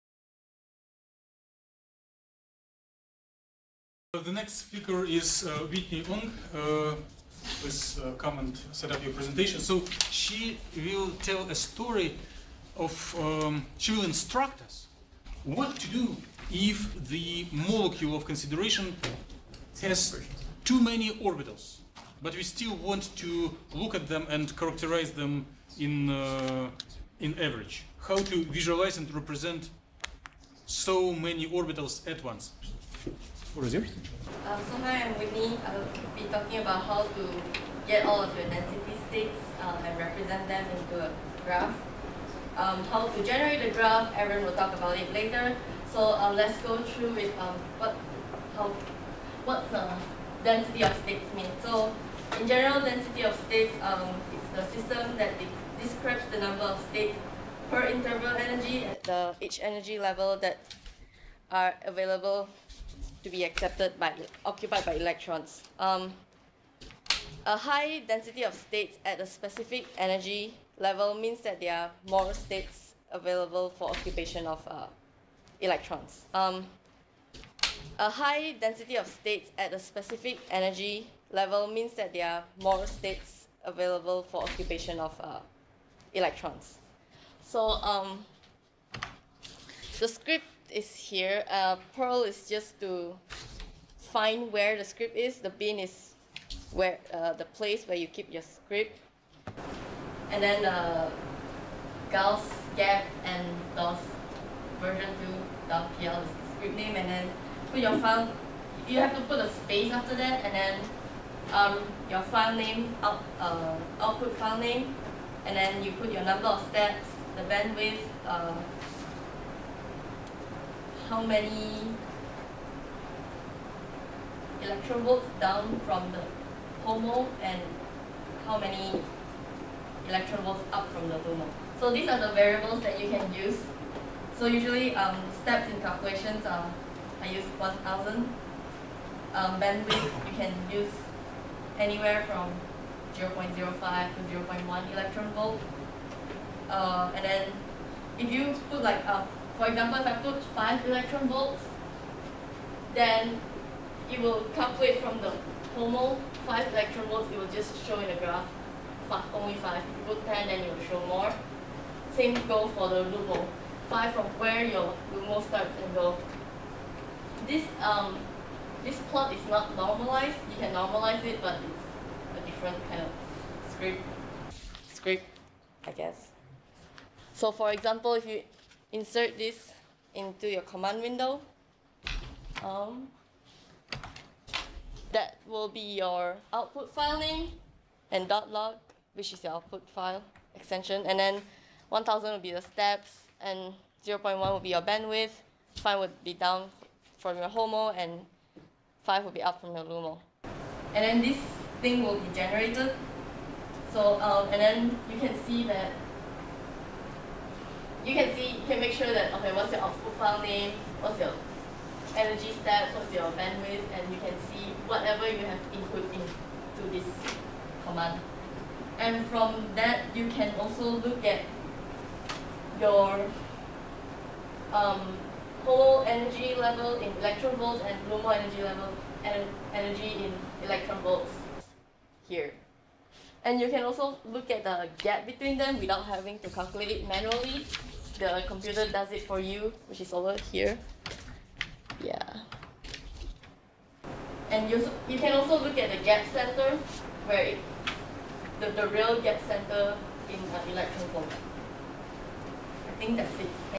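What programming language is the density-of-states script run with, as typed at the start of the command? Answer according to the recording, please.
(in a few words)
Perl.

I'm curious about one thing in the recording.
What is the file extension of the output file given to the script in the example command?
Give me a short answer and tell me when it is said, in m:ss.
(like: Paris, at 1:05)
.log, at 3:08.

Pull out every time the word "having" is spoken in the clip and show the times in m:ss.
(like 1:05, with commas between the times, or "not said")
3:56.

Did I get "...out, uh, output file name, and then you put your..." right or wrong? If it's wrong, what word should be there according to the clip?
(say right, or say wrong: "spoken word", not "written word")
right.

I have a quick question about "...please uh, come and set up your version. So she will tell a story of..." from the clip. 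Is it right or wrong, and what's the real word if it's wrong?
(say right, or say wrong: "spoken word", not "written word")
wrong: "presentation", not "version".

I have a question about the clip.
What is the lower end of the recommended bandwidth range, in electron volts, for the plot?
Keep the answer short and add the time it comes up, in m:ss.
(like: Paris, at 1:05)
0.05, at 2:23.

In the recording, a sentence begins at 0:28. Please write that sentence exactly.
How to visualize and represent so many orbitals at once.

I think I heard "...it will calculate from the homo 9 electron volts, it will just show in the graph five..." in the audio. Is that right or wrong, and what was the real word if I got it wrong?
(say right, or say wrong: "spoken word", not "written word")
wrong: "5", not "9".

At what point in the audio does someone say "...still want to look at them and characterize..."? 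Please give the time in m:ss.
0:22.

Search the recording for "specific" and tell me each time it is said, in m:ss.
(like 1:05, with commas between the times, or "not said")
1:09, 1:19.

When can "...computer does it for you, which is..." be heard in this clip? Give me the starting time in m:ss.
3:58.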